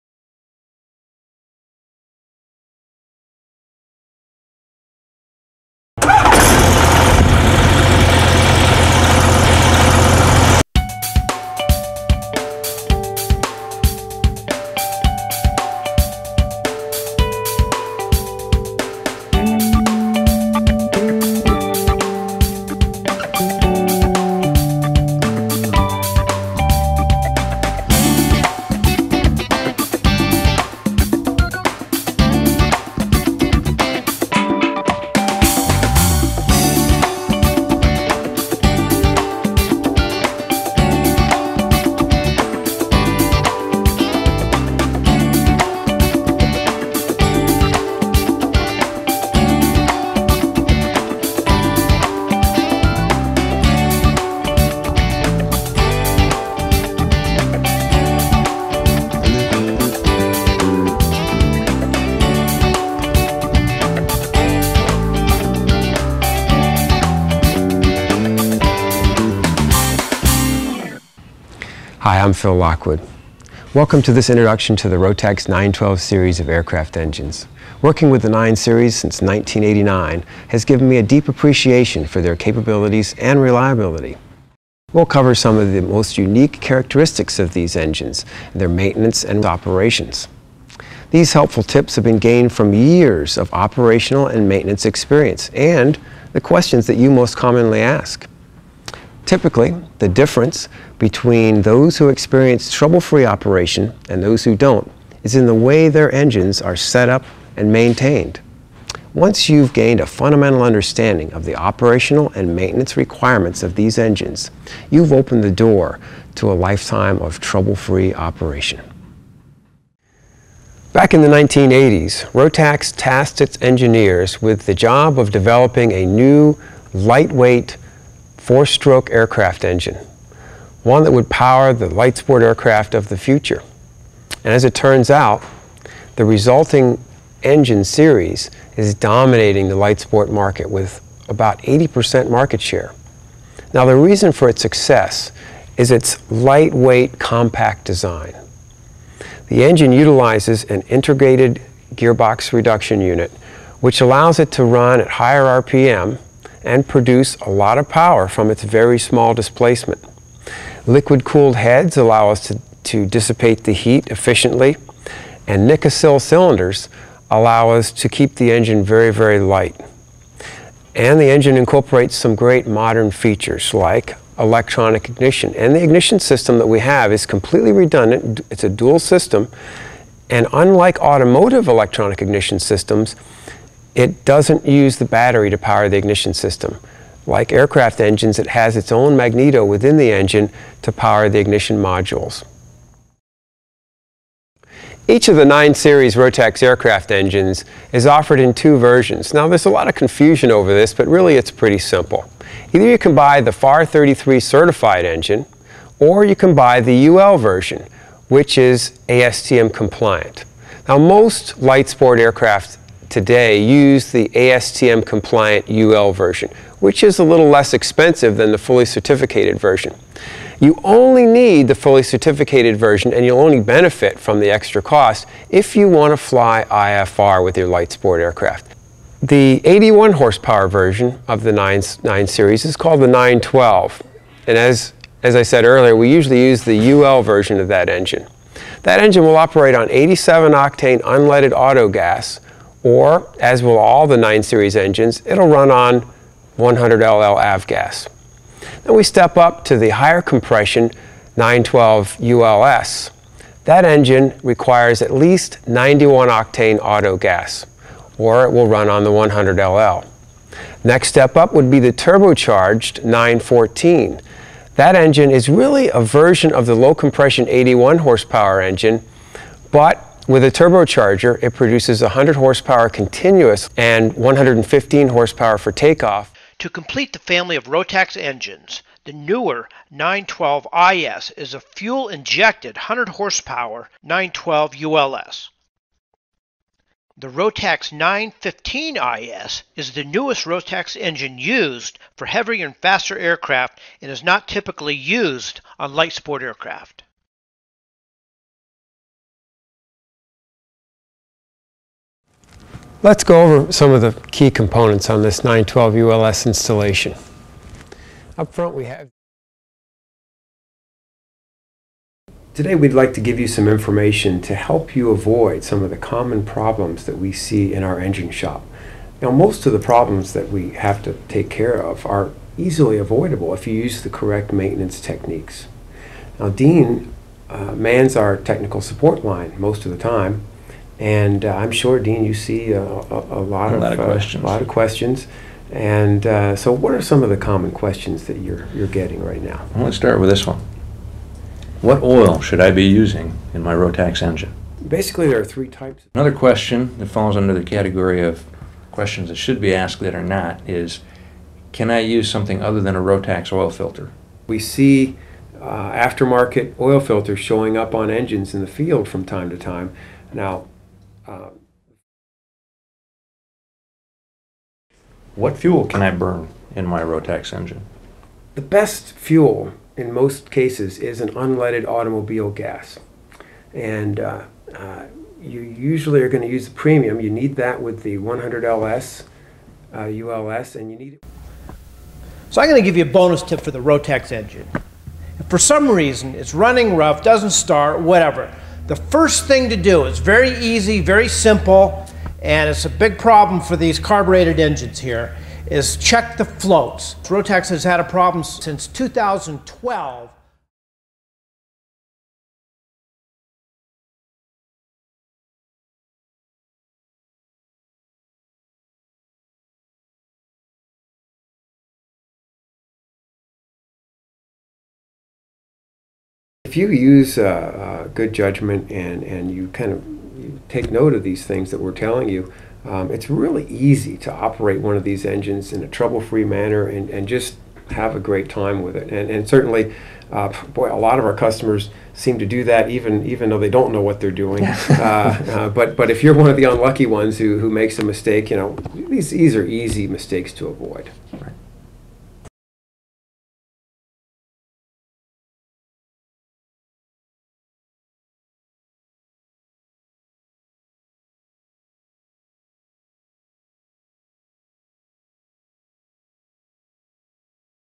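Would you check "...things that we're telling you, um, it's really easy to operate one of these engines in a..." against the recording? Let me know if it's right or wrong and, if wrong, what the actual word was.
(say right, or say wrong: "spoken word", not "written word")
right.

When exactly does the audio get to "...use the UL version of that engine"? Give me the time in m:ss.
3:56.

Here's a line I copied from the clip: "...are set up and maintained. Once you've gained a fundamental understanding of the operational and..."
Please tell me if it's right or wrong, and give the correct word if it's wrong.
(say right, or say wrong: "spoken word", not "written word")
right.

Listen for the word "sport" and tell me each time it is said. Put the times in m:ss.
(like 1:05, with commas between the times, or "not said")
2:12, 2:19, 3:31, 3:47, 4:56.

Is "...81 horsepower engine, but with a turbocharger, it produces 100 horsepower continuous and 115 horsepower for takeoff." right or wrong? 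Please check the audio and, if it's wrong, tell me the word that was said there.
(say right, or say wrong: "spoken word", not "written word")
right.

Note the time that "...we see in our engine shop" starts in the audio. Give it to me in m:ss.
5:17.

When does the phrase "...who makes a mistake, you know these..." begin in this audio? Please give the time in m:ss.
7:17.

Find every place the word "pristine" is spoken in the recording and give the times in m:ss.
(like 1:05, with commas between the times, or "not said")
not said.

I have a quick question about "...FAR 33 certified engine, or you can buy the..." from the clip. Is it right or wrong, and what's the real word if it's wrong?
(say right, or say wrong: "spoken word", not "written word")
right.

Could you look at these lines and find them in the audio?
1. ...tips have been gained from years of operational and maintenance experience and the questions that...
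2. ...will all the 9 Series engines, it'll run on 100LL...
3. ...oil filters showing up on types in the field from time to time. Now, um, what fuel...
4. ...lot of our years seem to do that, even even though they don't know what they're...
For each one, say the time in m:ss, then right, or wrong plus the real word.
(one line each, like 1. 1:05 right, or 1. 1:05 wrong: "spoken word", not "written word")
1. 1:31 right
2. 4:03 right
3. 5:56 wrong: "engines", not "types"
4. 7:10 wrong: "customers", not "years".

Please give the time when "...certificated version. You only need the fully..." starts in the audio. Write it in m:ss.
3:38.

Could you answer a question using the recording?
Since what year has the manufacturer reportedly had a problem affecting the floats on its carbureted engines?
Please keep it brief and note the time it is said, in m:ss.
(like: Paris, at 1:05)
2012, at 6:38.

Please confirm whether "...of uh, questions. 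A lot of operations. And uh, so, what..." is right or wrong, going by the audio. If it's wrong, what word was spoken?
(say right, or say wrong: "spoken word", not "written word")
wrong: "questions", not "operations".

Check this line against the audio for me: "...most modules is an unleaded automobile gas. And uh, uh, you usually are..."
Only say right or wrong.
wrong.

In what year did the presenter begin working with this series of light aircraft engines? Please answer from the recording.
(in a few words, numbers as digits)
1989.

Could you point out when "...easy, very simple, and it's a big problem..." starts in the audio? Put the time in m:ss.
6:30.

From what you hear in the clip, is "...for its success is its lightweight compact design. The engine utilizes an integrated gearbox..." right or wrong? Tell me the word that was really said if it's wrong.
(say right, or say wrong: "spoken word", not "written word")
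right.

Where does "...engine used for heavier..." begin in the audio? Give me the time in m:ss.
4:50.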